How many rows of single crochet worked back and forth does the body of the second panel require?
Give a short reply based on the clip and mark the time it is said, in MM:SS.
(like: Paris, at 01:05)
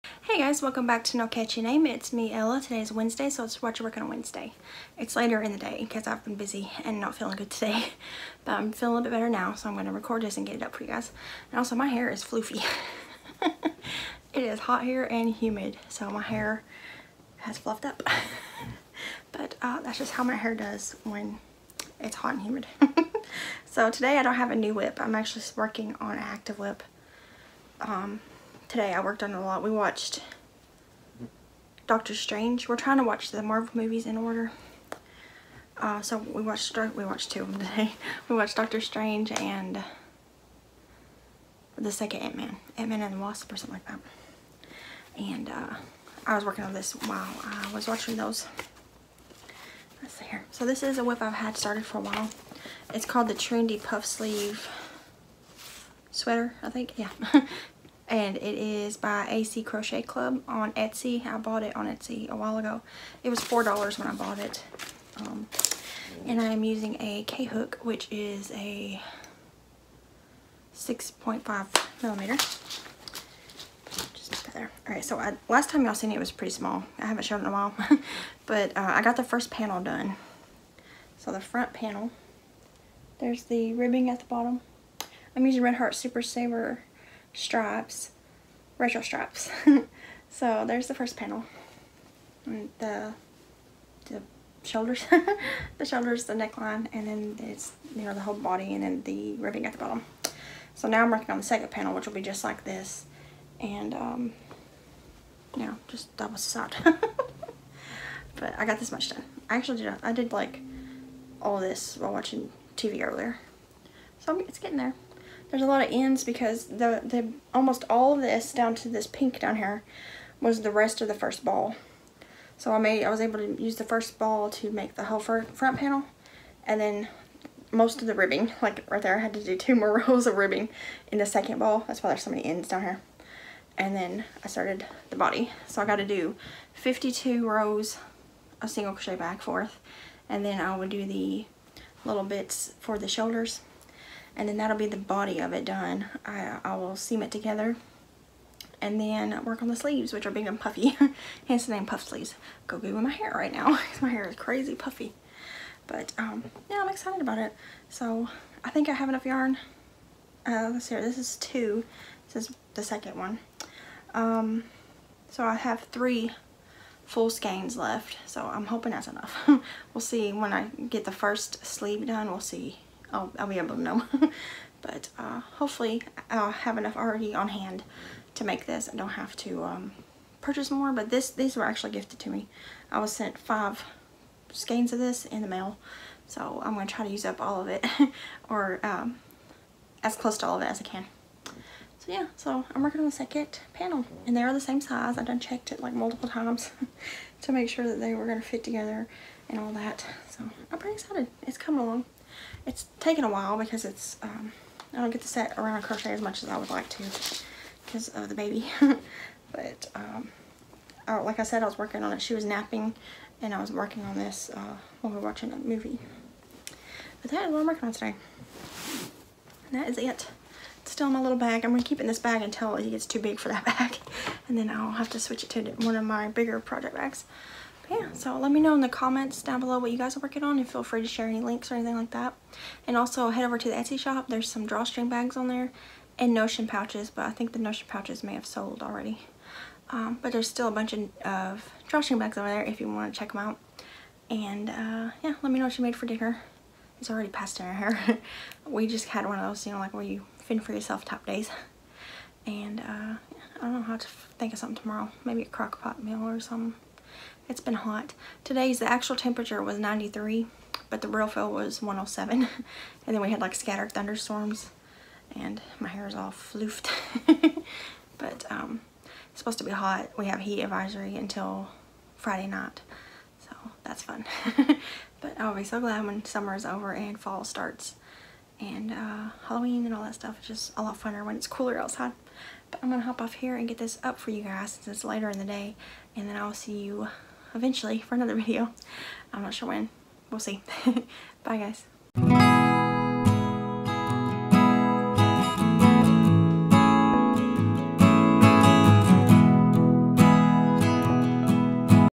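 52, at 02:16.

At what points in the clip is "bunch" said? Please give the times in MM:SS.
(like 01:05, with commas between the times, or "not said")
04:00.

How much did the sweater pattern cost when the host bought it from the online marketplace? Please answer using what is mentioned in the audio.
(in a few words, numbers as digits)
$4.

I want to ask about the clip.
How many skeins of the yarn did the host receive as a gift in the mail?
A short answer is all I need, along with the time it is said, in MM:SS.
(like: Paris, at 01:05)
5, at 03:03.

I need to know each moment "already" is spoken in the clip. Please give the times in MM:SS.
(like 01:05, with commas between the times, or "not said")
02:56, 03:58, 04:07.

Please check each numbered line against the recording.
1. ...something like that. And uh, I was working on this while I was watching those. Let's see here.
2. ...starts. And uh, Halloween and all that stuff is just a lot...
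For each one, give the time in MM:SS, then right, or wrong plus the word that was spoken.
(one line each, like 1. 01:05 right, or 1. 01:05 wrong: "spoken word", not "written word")
1. 00:43 right
2. 04:37 right.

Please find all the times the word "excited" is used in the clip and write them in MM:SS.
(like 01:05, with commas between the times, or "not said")
02:36, 03:20.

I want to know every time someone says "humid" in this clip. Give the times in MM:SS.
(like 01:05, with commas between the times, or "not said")
00:15, 00:22.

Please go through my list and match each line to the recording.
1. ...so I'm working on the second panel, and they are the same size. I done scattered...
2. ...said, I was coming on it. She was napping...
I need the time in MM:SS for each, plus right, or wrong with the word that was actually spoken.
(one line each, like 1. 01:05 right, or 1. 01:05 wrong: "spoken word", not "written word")
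1. 03:12 wrong: "checked", not "scattered"
2. 03:31 wrong: "working", not "coming".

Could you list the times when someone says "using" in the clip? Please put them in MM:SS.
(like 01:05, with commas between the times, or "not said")
01:06, 01:25.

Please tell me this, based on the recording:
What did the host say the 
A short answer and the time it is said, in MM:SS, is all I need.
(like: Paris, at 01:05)
107, at 04:21.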